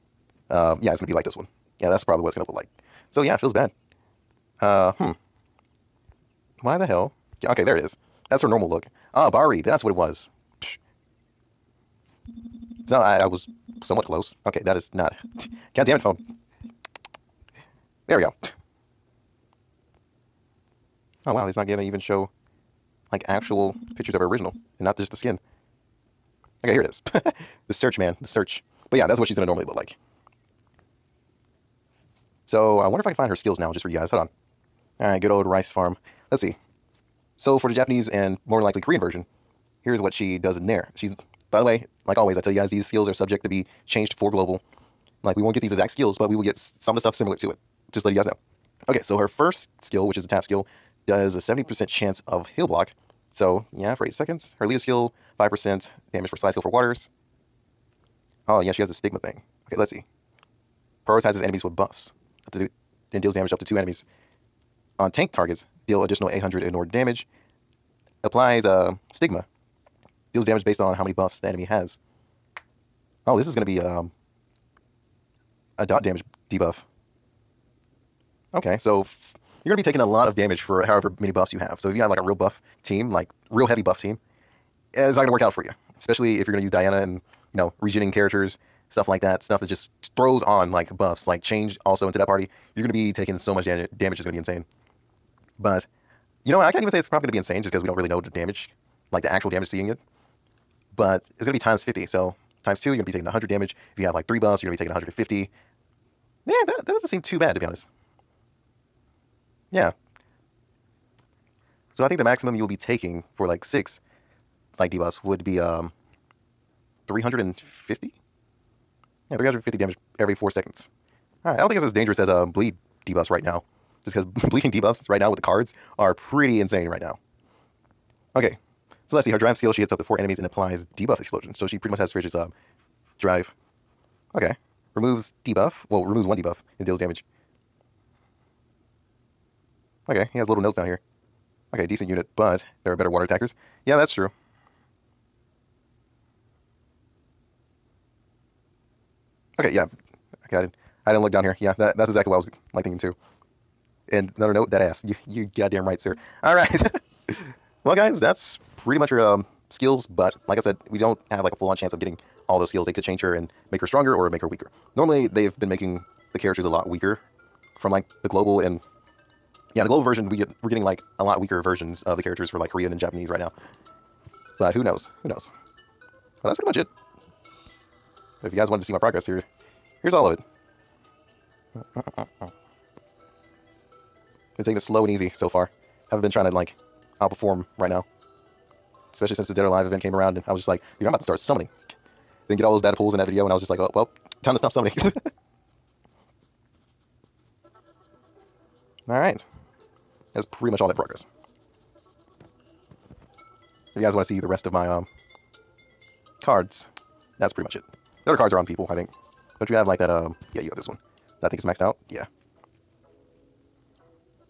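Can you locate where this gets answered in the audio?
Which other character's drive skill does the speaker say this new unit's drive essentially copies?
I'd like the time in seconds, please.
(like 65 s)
132 s.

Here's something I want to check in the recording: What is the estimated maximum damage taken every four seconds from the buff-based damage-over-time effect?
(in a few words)
350.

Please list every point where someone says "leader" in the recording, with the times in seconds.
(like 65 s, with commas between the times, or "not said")
54 s.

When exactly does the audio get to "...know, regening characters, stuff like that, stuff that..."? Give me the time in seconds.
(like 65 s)
87 s.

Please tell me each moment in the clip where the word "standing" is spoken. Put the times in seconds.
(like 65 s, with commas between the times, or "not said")
not said.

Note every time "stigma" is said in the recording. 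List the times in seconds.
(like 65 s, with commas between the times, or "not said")
58 s, 69 s.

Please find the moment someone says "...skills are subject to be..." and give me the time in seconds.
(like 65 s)
42 s.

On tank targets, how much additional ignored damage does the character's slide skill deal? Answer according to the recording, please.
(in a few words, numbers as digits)
800.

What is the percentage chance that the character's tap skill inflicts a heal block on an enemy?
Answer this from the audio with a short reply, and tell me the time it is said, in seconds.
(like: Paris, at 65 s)
70%, at 51 s.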